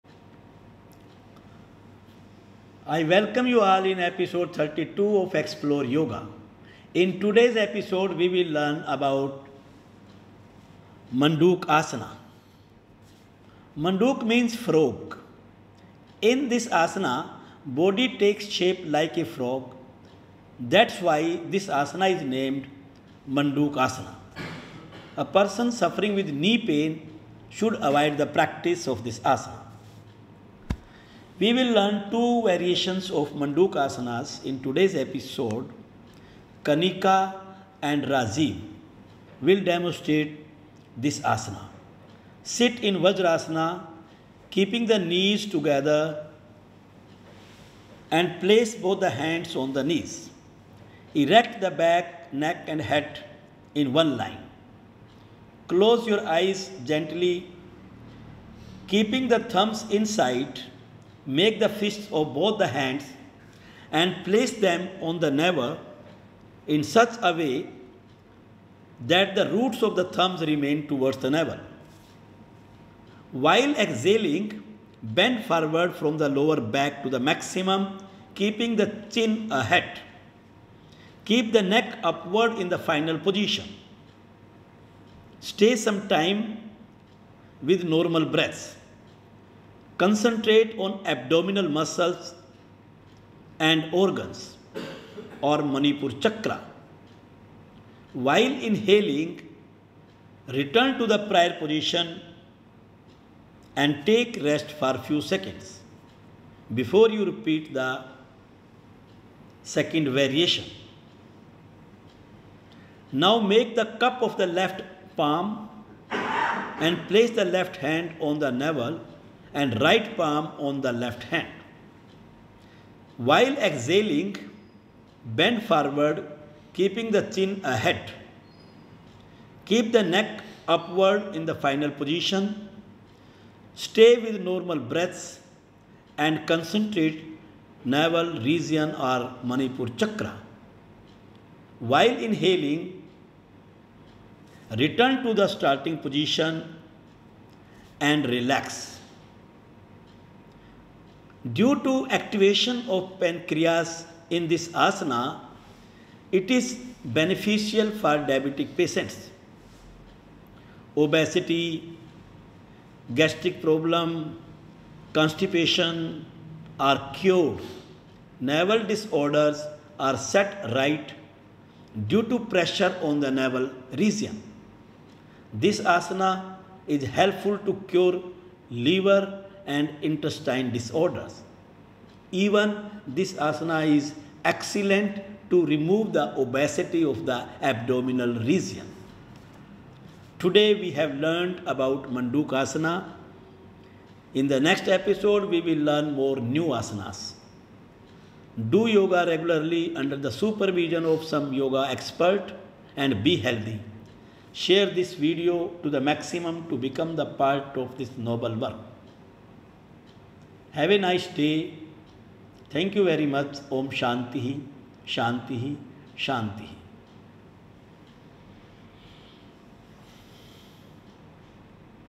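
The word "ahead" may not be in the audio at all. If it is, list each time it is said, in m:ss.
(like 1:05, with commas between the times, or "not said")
1:19, 2:07.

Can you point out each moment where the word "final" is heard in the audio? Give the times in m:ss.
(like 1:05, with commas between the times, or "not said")
1:22, 2:11.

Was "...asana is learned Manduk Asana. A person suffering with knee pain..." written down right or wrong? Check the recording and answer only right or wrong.
wrong.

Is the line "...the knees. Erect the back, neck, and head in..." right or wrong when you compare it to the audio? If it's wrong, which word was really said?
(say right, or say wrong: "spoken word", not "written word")
right.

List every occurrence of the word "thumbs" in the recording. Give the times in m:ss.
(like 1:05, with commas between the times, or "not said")
0:59, 1:10.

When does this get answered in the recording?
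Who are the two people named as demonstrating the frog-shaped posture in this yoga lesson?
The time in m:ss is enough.
0:36.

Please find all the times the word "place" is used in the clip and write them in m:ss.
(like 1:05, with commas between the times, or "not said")
0:48, 1:04, 1:57.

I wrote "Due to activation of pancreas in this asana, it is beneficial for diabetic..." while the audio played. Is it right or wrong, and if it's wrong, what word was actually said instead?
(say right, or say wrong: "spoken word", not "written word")
right.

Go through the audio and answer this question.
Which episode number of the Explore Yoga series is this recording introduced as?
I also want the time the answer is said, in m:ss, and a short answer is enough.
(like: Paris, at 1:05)
32, at 0:04.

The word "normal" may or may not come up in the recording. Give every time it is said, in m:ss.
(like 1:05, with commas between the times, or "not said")
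1:27, 2:14.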